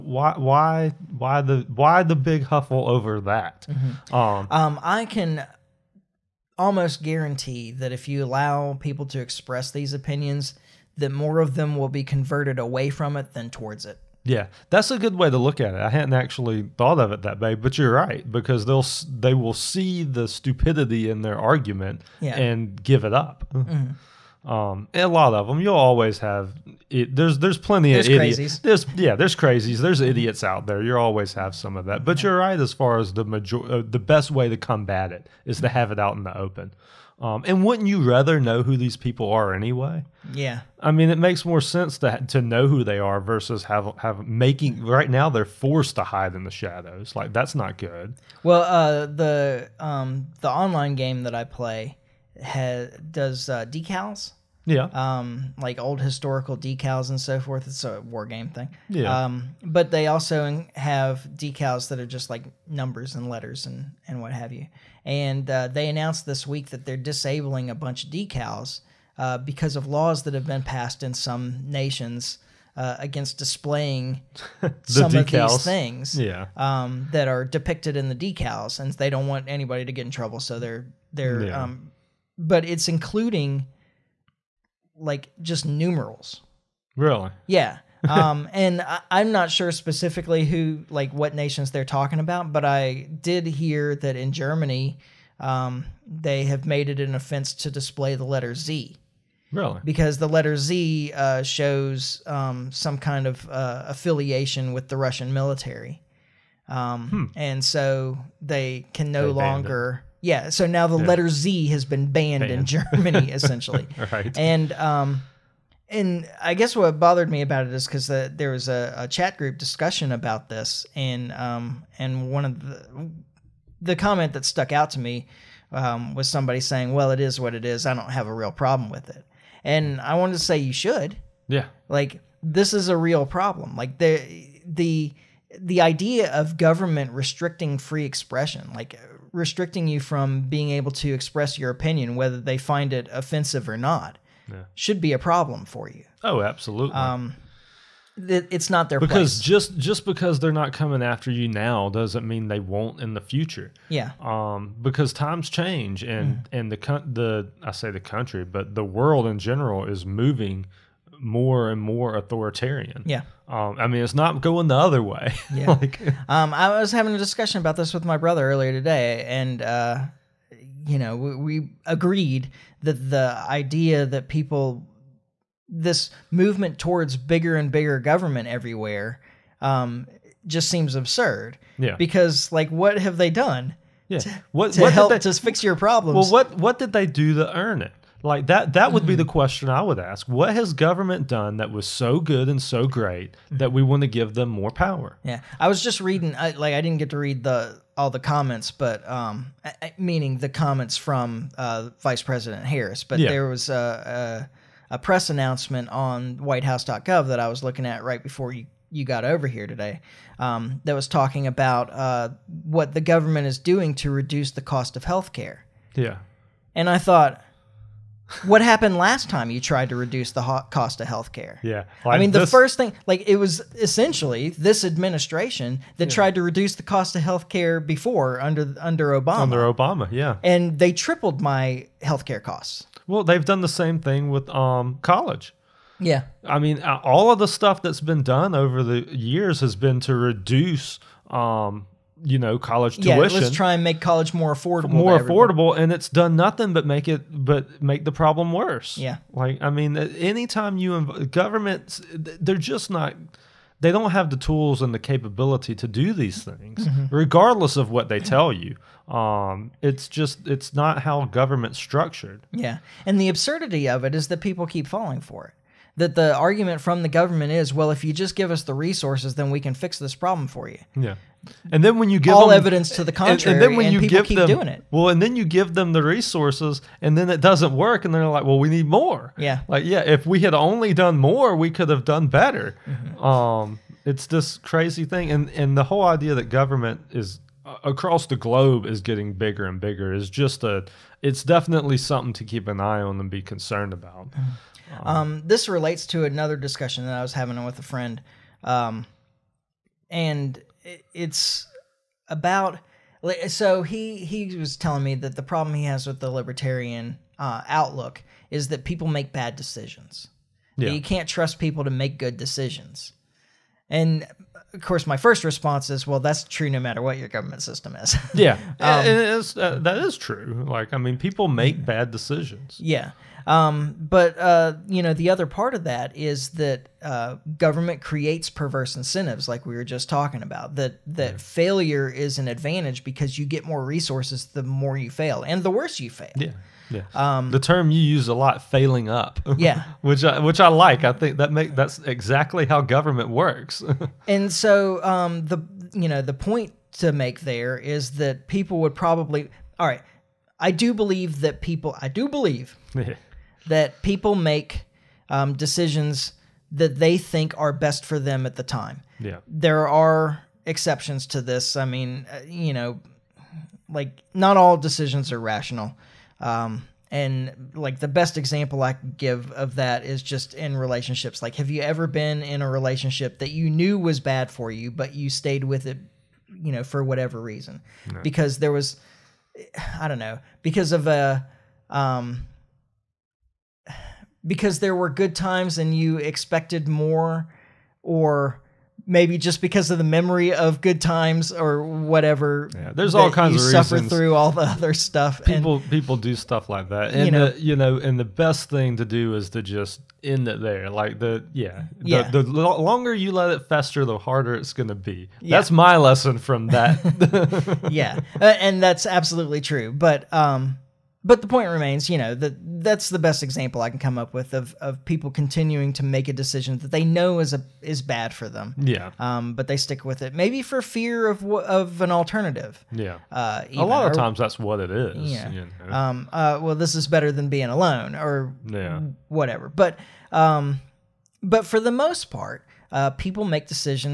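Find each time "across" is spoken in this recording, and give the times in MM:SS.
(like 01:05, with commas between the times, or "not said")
04:47.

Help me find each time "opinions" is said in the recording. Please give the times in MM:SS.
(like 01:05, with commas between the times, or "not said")
00:09, 02:21.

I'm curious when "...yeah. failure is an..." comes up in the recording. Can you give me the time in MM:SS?
05:31.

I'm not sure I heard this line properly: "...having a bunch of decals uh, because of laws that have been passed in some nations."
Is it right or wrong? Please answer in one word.
wrong.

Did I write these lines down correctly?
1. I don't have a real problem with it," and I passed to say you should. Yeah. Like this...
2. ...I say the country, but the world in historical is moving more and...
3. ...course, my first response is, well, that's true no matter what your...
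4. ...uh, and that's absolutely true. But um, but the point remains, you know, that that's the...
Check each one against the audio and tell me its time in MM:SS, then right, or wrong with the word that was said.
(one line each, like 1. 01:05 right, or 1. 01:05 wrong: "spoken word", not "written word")
1. 02:07 wrong: "wanted", not "passed"
2. 02:37 wrong: "general", not "historical"
3. 05:14 right
4. 06:48 right.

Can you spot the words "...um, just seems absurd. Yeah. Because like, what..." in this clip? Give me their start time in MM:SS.
02:59.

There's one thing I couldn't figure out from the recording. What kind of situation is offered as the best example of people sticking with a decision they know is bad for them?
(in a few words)
Relationships.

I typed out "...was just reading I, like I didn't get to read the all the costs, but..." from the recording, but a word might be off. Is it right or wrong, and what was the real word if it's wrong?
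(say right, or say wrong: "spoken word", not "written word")
wrong: "comments", not "costs".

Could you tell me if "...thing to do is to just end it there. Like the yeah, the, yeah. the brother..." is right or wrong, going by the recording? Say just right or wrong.
wrong.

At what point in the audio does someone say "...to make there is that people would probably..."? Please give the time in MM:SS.
05:46.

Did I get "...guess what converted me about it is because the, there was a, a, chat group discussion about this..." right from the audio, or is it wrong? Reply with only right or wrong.
wrong.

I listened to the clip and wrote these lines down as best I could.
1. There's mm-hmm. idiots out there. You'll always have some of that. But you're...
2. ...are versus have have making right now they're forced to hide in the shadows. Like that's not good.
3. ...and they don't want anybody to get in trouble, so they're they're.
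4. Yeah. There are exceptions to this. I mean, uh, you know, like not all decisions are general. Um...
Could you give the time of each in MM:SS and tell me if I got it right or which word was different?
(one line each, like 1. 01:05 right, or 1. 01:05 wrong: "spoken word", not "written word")
1. 00:29 right
2. 00:42 right
3. 01:18 right
4. 05:59 wrong: "rational", not "general".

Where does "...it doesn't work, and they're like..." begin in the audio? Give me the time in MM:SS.
04:37.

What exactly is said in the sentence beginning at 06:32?
Yeah, there's all kinds you of suffer reasons.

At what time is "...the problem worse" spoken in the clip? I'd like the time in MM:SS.
04:08.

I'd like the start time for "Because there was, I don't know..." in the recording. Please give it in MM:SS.
06:18.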